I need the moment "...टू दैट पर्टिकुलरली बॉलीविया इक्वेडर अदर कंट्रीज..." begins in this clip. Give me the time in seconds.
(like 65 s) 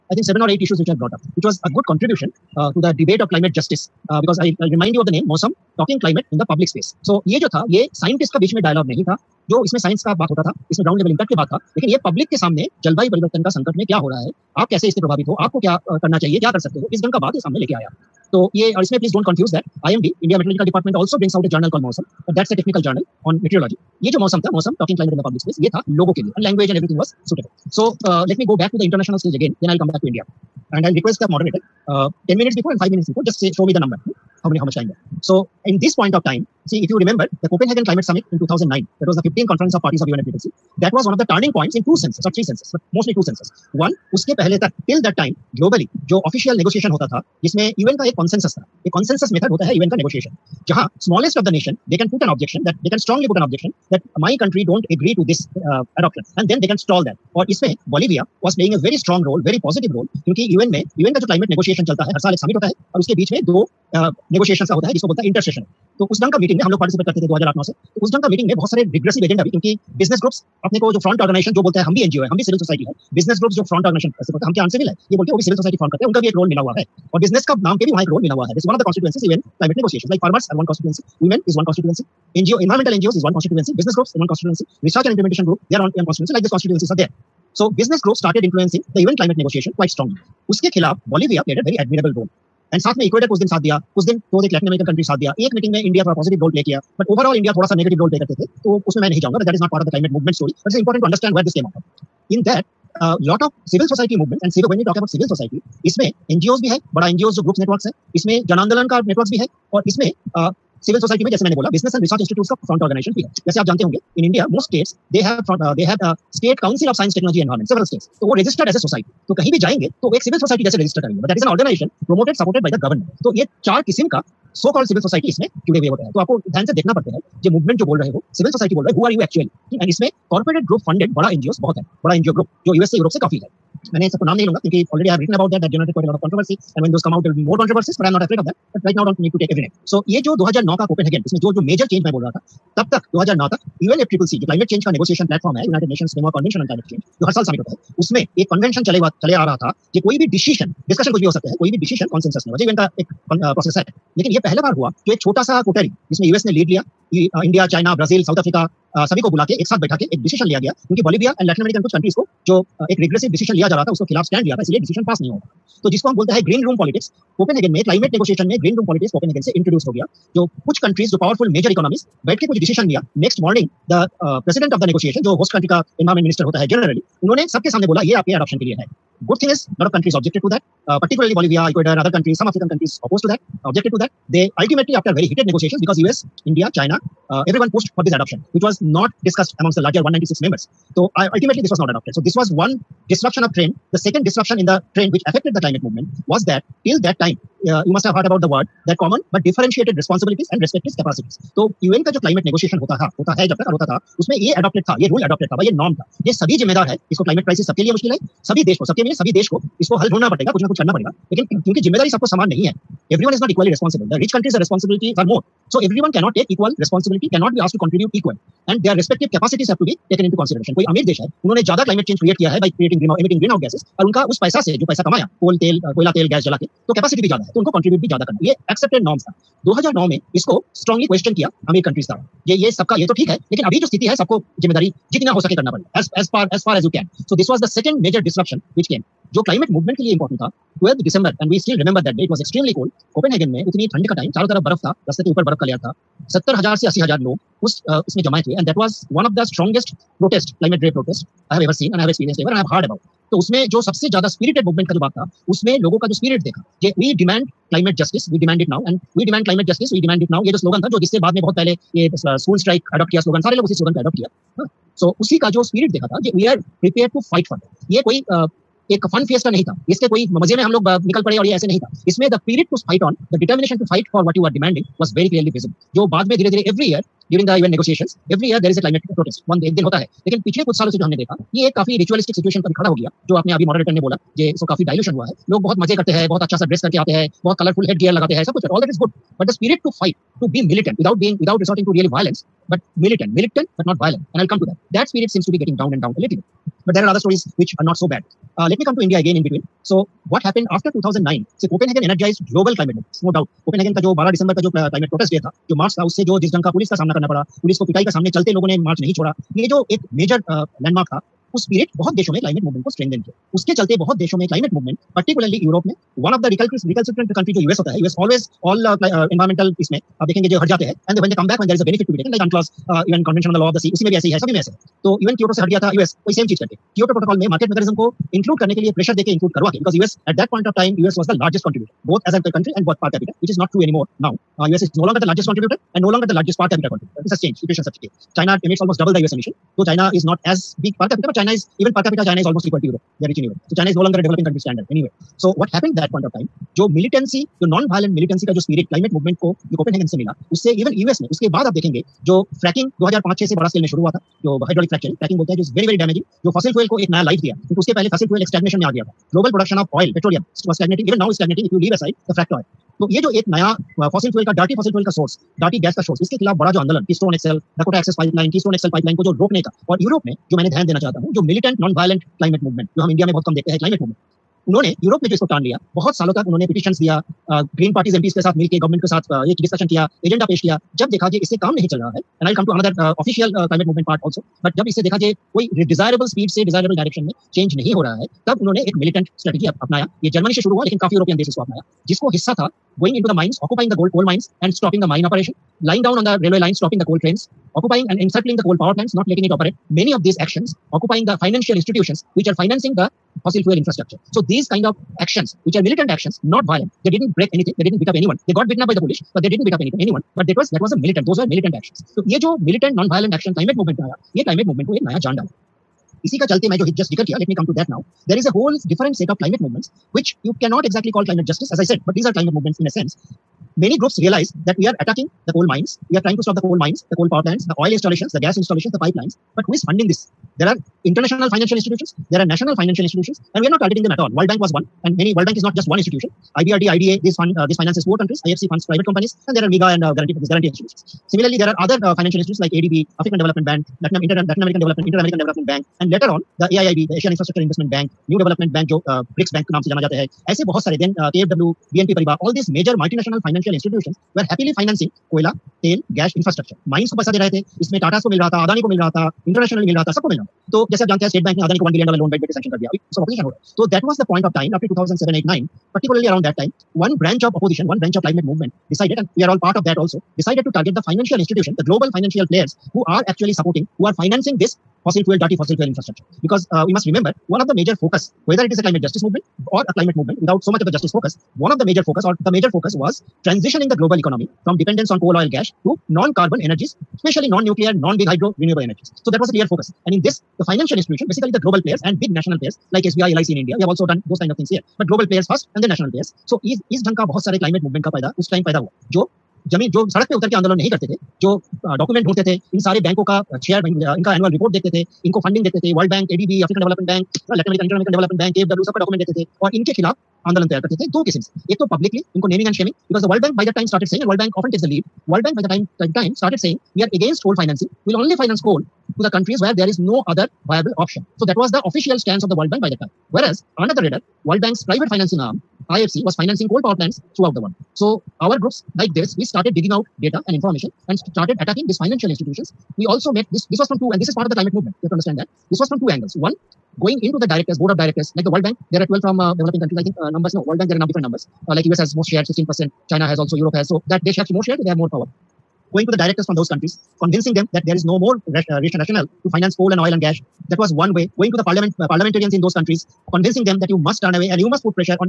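180 s.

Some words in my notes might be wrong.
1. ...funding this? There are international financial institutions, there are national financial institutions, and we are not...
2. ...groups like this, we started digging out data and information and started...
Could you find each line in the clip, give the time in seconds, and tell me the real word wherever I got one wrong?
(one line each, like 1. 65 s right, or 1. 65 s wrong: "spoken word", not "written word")
1. 429 s right
2. 528 s right.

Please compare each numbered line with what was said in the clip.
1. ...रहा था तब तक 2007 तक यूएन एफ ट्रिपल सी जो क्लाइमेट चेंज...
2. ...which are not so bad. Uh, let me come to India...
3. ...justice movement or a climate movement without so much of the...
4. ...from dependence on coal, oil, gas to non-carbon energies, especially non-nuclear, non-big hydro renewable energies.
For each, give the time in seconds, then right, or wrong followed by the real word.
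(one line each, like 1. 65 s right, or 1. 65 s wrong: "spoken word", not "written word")
1. 142 s wrong: "2009", not "2007"
2. 297 s right
3. 479 s right
4. 484 s right.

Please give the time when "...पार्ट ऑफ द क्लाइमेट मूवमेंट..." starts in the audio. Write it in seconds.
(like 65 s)
99 s.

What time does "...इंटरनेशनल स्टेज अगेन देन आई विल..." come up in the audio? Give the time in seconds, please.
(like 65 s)
28 s.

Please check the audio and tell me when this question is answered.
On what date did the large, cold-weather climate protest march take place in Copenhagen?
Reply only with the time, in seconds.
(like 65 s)
240 s.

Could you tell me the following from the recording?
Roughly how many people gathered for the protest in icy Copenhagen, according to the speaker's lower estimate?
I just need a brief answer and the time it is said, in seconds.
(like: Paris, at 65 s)
70,000, at 246 s.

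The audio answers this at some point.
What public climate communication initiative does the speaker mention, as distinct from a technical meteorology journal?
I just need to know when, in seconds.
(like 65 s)
5 s.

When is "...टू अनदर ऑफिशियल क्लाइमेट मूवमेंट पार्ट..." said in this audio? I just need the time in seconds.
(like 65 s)
382 s.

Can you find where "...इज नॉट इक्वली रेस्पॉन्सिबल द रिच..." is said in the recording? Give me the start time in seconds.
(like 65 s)
213 s.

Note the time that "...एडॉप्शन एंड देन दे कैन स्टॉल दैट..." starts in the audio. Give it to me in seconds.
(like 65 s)
55 s.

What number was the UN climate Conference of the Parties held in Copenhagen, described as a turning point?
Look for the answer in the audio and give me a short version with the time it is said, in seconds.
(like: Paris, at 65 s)
15th, at 39 s.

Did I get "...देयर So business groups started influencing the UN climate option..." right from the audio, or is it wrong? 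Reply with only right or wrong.
wrong.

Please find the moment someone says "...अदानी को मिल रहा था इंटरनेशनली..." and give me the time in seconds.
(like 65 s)
458 s.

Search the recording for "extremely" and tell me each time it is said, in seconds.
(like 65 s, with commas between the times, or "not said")
242 s.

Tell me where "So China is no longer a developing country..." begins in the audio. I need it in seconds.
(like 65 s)
343 s.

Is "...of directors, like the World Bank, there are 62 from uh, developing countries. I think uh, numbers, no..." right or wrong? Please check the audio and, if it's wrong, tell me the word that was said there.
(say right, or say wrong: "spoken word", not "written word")
wrong: "12", not "62".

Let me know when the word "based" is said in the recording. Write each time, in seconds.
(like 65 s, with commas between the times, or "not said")
not said.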